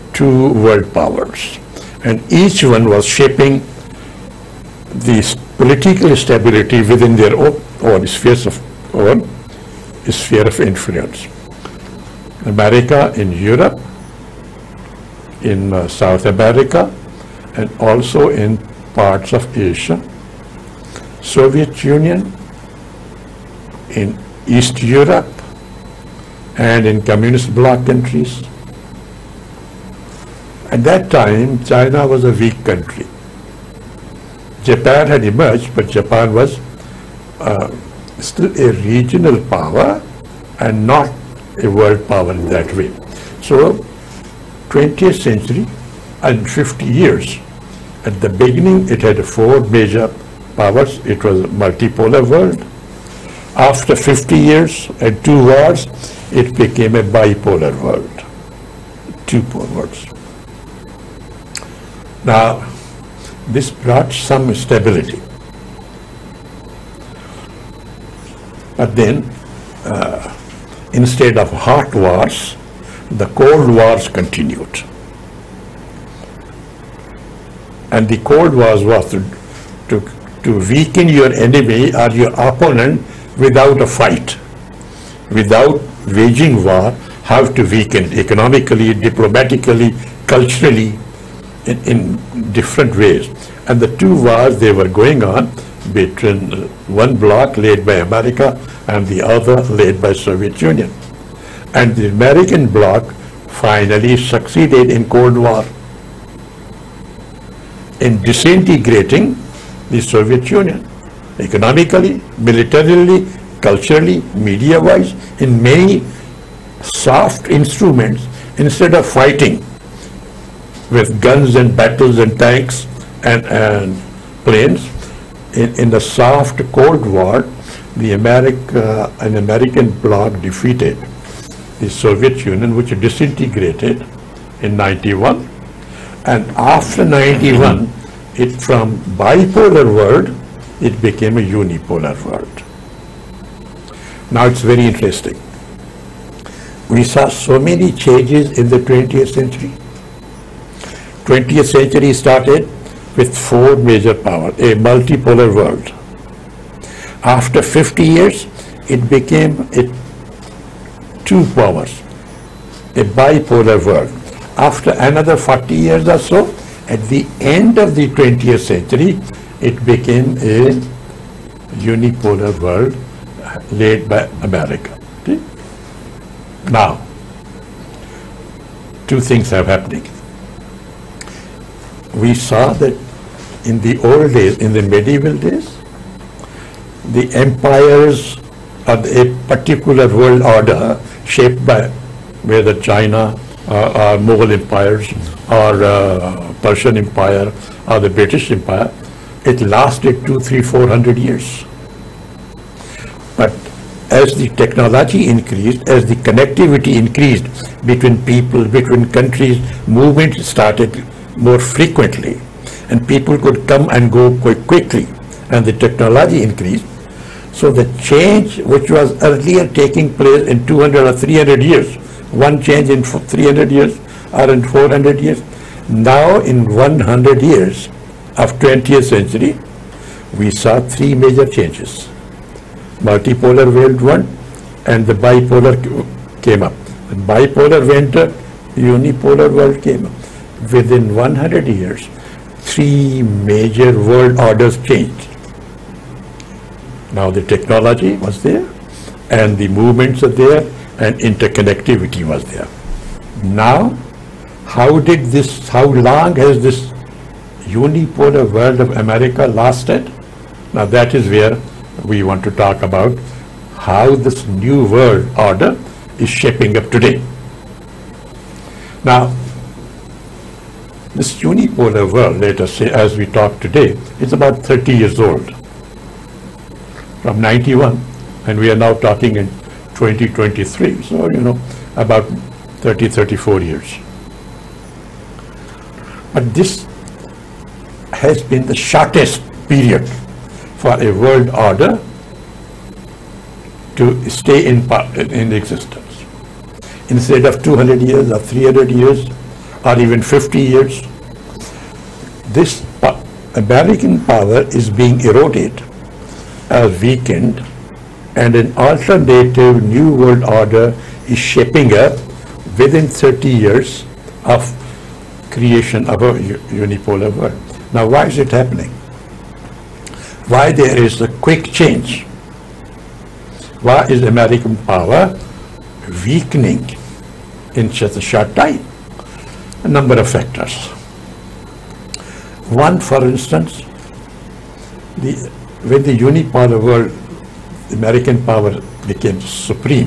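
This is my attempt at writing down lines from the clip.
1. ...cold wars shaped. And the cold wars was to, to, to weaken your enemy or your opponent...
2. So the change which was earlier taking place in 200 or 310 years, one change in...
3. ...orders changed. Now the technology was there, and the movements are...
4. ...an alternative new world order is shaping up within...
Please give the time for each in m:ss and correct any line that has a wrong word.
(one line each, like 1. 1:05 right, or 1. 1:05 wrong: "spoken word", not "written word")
1. 1:13 wrong: "continued", not "shaped"
2. 3:37 wrong: "300", not "310"
3. 4:04 right
4. 5:08 right.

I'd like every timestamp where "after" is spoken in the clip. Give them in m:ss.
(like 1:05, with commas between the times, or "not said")
0:53, 2:16, 2:37, 2:44.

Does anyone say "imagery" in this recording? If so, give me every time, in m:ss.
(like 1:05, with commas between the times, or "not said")
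not said.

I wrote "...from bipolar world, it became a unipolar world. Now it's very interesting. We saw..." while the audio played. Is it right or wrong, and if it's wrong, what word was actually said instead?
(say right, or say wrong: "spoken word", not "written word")
right.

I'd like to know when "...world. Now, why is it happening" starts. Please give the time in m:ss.
5:17.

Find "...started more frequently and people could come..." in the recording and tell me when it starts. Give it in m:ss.
3:30.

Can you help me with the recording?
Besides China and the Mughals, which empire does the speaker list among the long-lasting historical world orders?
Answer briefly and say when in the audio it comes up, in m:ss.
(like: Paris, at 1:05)
Persian empire, at 3:16.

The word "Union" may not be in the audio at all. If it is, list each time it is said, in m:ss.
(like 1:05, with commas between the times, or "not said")
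0:21, 1:40, 1:50, 2:12.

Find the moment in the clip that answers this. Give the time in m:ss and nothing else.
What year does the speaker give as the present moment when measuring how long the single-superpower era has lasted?
4:39.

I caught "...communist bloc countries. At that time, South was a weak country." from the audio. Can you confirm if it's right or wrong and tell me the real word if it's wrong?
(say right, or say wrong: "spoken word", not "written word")
wrong: "China", not "South".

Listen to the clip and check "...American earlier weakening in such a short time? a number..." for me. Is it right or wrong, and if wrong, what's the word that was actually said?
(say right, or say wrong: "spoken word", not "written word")
wrong: "power", not "earlier".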